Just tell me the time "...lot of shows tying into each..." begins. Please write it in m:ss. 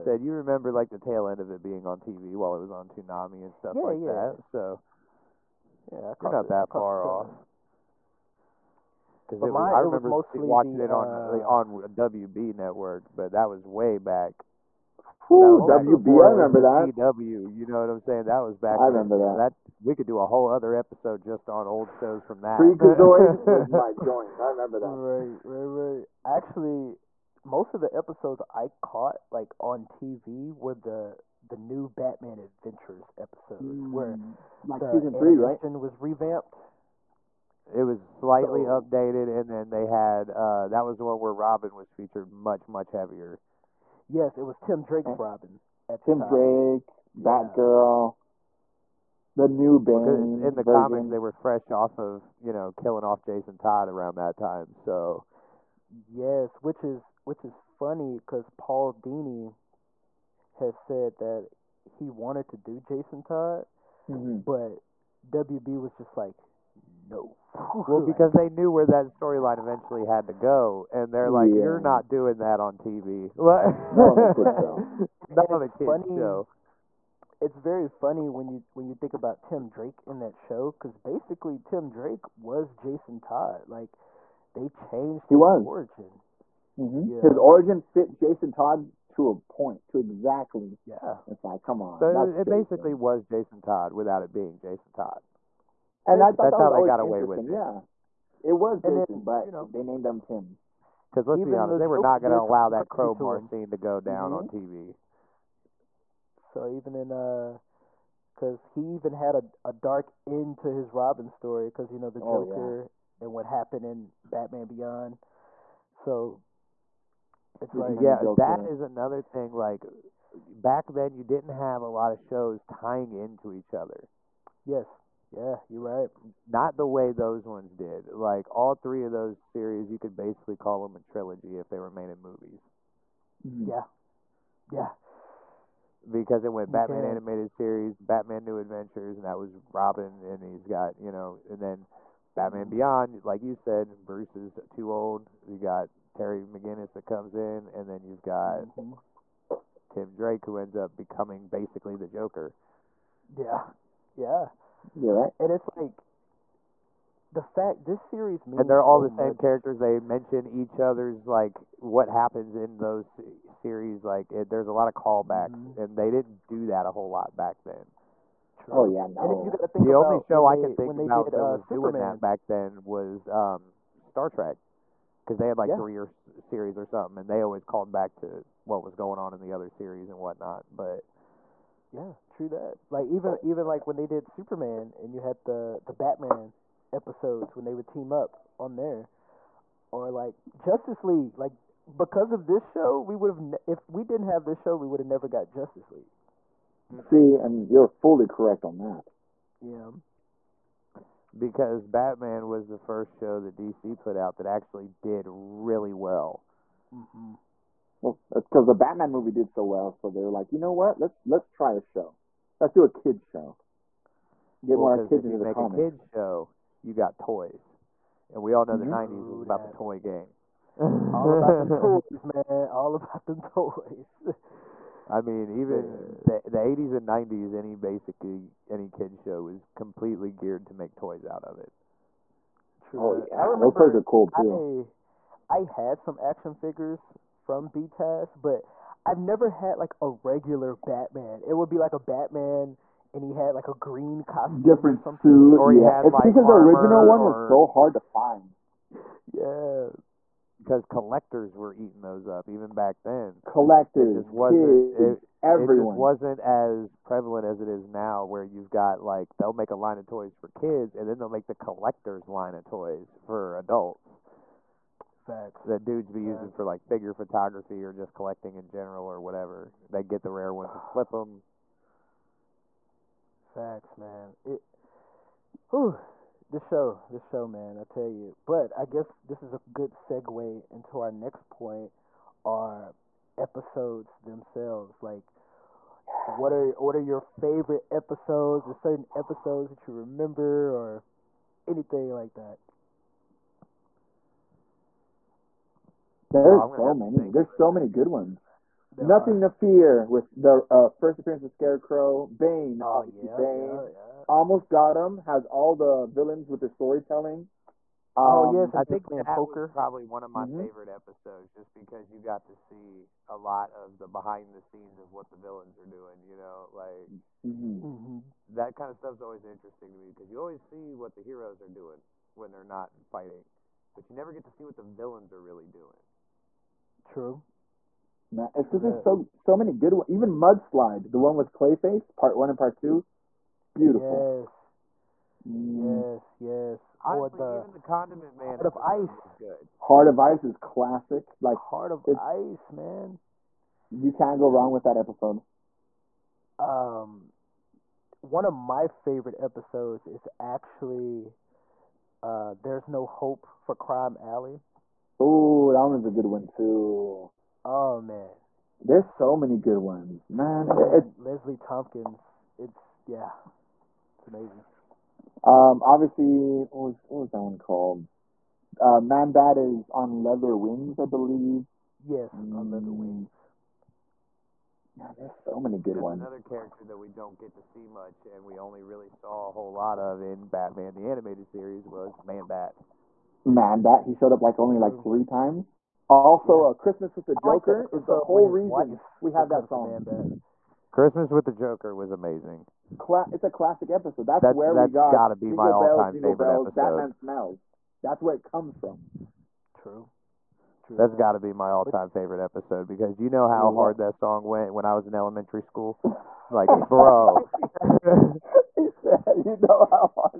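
2:01.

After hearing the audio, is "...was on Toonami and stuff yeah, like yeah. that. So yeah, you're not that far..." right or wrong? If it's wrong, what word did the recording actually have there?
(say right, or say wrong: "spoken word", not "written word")
right.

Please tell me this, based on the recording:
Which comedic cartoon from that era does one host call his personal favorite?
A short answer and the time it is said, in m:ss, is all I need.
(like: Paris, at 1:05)
Freakazoid, at 0:22.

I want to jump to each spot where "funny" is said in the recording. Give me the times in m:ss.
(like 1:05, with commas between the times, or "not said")
0:57, 1:17.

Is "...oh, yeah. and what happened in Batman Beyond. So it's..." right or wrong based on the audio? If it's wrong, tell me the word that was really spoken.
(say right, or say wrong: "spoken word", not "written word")
right.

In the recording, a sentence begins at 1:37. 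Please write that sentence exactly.
Yeah, it was Jason, then, but you know, they named him Tim.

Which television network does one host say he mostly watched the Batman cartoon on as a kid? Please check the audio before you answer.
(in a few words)
WB network.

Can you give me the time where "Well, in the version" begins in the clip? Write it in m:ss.
0:50.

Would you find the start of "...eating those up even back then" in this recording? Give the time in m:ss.
4:11.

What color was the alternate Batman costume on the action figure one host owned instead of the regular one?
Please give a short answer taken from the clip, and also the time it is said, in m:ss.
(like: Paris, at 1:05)
Green, at 4:03.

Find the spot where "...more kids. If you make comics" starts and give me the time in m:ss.
3:34.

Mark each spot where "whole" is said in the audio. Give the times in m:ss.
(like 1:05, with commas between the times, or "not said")
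0:20, 2:46, 6:19, 6:28.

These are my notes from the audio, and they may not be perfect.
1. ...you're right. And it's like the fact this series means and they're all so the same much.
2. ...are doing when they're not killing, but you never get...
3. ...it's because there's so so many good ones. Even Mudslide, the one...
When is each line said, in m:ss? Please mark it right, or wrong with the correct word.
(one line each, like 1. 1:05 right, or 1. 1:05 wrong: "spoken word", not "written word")
1. 2:34 right
2. 5:21 wrong: "fighting", not "killing"
3. 5:28 right.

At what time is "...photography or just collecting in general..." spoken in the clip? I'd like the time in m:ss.
4:27.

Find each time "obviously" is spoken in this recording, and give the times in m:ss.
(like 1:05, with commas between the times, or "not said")
5:02, 6:05.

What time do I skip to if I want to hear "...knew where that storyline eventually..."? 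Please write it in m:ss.
1:08.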